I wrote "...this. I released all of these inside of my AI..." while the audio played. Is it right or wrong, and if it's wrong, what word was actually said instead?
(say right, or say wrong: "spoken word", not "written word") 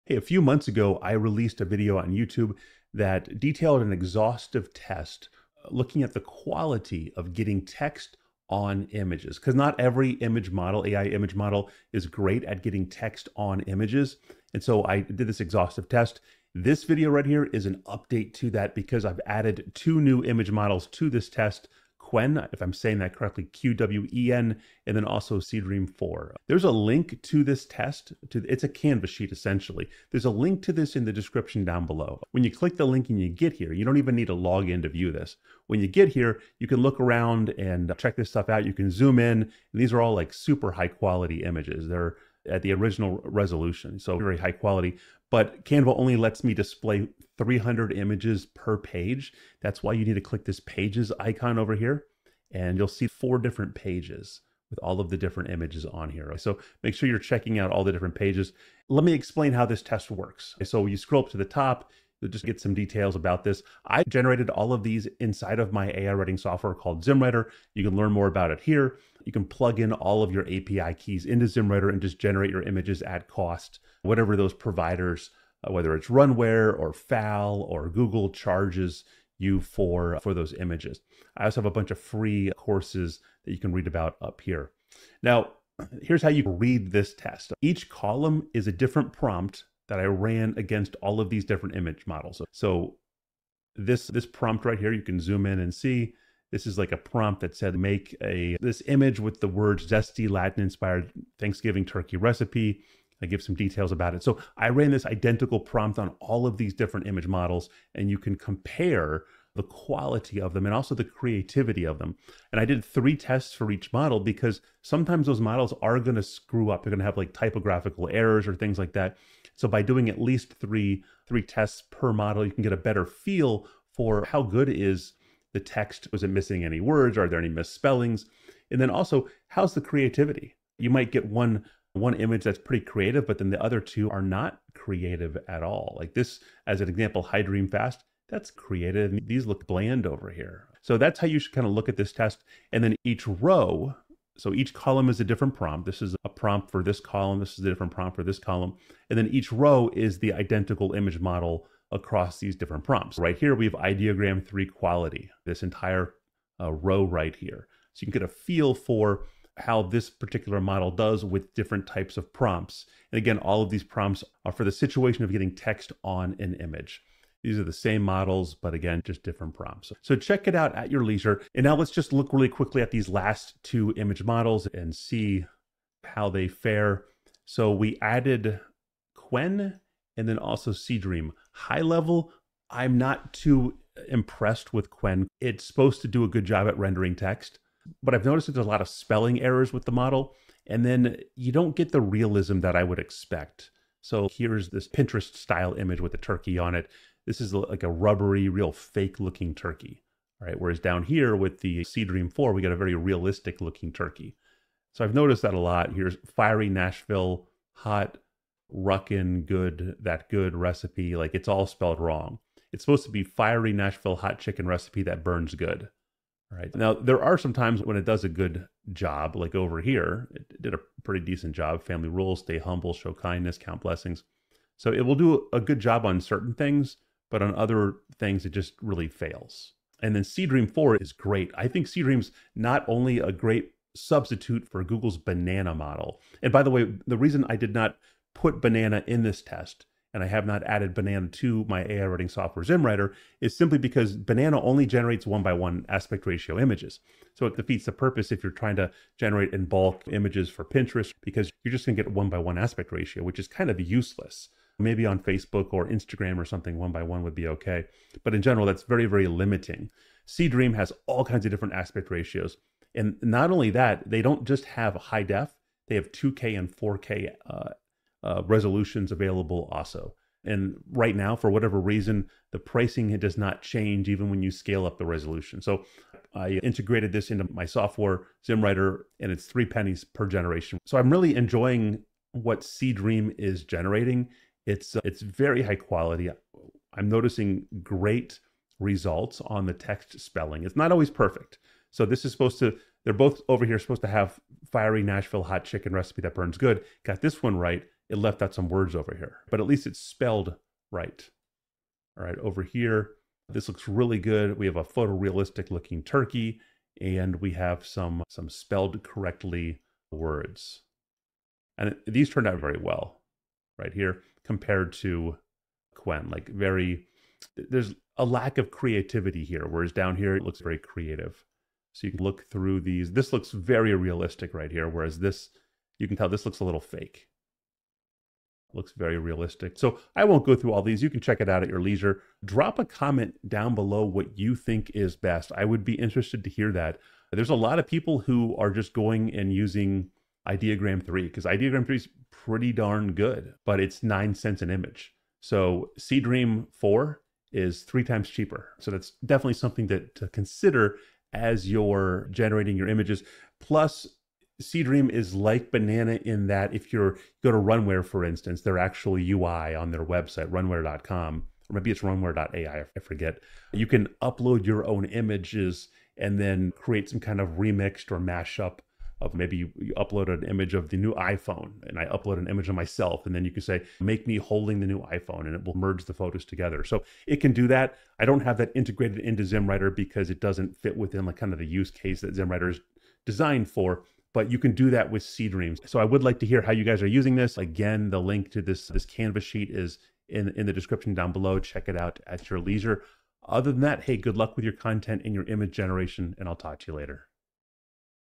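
wrong: "generated", not "released".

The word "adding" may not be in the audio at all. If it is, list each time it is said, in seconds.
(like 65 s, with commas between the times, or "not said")
not said.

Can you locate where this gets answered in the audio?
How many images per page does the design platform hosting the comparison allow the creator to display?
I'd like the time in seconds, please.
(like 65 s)
47 s.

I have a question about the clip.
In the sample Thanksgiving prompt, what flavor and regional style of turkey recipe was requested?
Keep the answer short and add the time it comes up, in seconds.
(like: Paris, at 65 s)
Zesty Latin inspired, at 99 s.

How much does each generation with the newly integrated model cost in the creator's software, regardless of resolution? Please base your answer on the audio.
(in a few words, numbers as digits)
3 cents.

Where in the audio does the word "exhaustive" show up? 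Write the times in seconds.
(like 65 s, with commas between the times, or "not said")
3 s, 15 s.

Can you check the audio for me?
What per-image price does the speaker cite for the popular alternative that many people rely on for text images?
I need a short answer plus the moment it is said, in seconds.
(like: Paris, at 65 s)
9 cents, at 344 s.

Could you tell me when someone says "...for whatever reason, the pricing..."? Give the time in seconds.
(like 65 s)
271 s.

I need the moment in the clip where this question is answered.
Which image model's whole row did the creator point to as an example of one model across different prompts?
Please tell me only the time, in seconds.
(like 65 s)
153 s.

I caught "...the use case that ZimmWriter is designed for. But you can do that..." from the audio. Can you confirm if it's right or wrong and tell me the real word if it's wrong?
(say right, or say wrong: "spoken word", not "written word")
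right.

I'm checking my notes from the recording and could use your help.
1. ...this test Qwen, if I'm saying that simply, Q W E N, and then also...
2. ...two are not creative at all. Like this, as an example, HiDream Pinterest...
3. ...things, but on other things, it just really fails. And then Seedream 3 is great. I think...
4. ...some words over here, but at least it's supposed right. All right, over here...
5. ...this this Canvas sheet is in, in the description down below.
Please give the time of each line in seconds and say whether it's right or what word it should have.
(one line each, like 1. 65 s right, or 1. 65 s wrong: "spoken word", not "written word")
1. 21 s wrong: "correctly", not "simply"
2. 133 s wrong: "Fast", not "Pinterest"
3. 226 s wrong: "4", not "3"
4. 298 s wrong: "spelled", not "supposed"
5. 388 s right.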